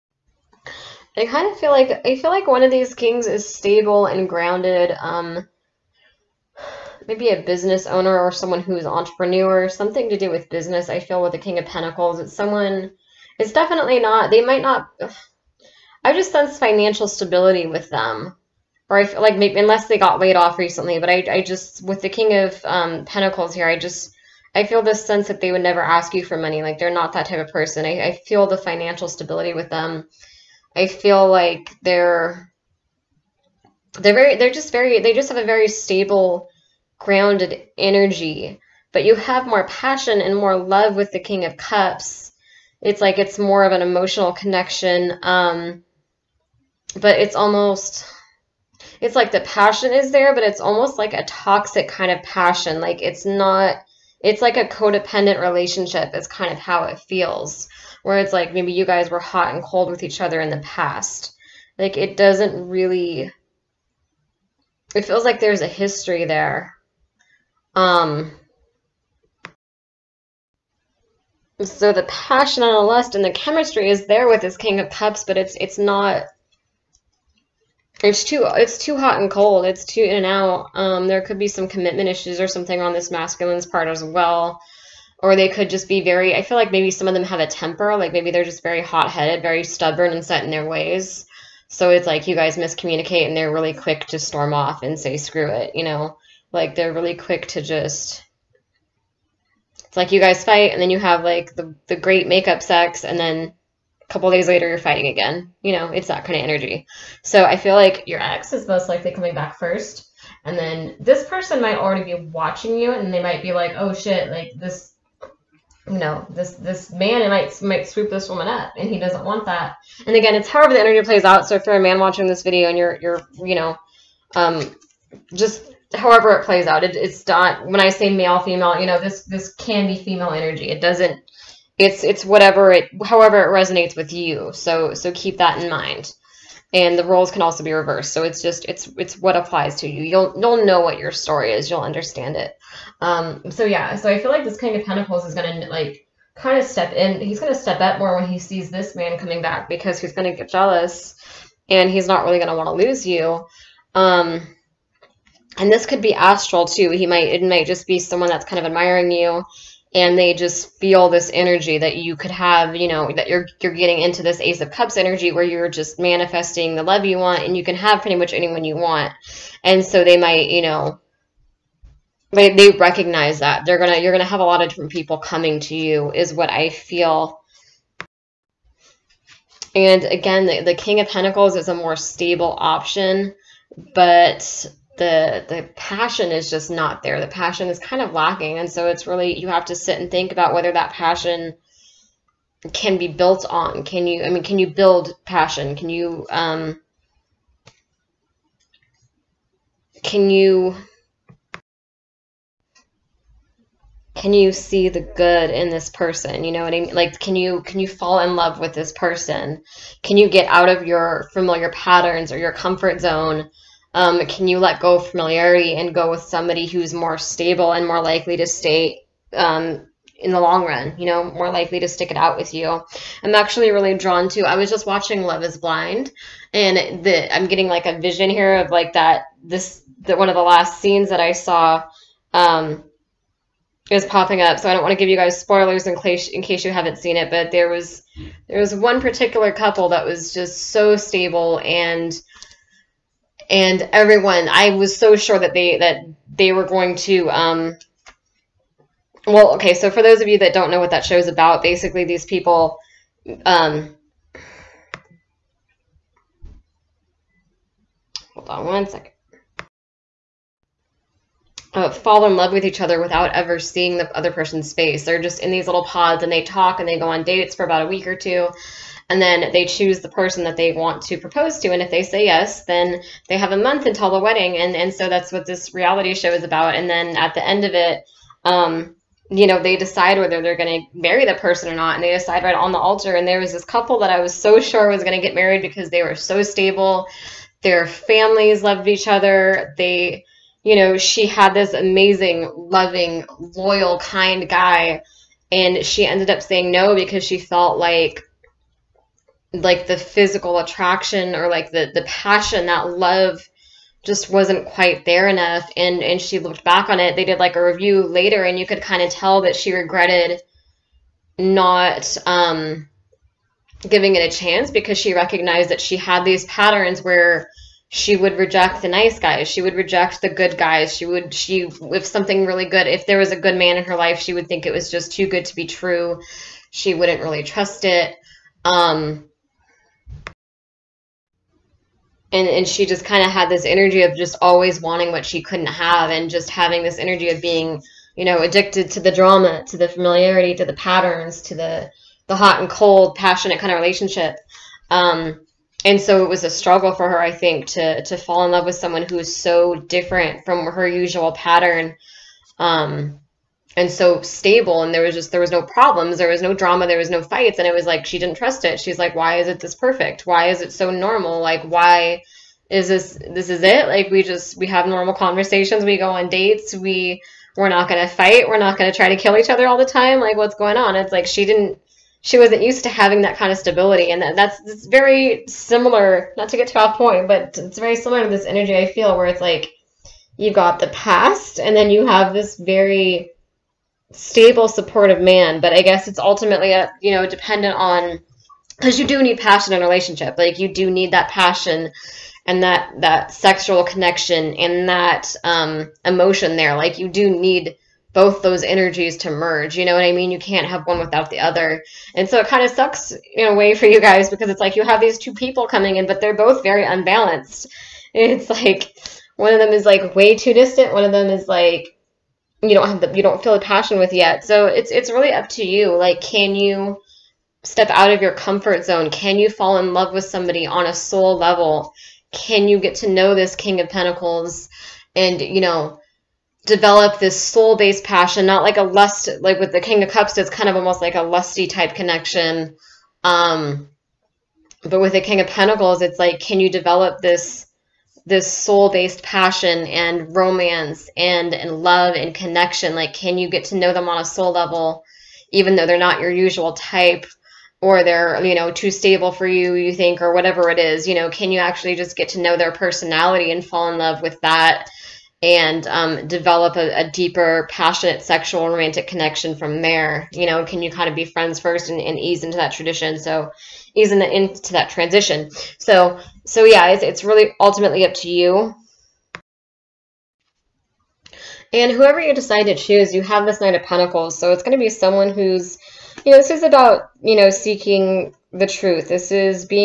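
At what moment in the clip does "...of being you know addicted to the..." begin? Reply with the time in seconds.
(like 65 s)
337 s.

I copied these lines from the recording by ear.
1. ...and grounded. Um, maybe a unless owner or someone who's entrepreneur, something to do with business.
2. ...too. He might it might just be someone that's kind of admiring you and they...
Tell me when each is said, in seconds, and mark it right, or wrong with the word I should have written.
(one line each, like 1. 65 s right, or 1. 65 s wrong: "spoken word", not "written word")
1. 4 s wrong: "business", not "unless"
2. 156 s right.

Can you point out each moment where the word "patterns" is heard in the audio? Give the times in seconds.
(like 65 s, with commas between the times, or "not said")
211 s, 316 s, 340 s, 351 s.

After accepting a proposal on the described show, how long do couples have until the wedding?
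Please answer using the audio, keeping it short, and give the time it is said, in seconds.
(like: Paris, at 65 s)
a month, at 273 s.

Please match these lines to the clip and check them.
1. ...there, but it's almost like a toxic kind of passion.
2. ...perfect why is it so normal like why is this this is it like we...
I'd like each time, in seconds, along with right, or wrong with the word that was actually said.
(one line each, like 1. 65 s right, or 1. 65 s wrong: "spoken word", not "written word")
1. 50 s right
2. 359 s right.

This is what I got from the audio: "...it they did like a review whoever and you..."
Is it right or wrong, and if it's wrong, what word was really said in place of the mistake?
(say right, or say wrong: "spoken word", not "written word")
wrong: "later", not "whoever".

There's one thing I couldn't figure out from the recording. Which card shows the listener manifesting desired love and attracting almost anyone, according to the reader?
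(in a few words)
Ace of Cups.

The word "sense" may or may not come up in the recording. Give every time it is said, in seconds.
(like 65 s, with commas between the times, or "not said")
16 s, 25 s.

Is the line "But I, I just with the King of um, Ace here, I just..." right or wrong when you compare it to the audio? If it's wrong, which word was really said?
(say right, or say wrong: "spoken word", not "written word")
wrong: "Pentacles", not "Ace".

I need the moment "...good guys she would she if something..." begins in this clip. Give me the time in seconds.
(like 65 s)
320 s.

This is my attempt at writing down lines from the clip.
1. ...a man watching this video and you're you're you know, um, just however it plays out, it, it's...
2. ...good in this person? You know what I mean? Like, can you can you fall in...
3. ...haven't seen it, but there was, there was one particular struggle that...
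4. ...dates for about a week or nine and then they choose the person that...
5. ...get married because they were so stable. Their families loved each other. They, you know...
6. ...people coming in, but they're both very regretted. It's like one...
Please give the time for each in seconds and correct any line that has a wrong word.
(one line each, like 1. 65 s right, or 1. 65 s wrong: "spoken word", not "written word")
1. 121 s right
2. 205 s right
3. 236 s wrong: "couple", not "struggle"
4. 267 s wrong: "two", not "nine"
5. 285 s right
6. 405 s wrong: "unbalanced", not "regretted".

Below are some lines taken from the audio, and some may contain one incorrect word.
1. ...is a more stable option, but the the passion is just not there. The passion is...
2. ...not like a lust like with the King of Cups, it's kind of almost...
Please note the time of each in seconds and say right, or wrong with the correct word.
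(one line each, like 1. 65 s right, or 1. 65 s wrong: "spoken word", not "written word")
1. 181 s right
2. 428 s right.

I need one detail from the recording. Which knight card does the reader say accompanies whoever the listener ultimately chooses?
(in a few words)
Knight of Pentacles.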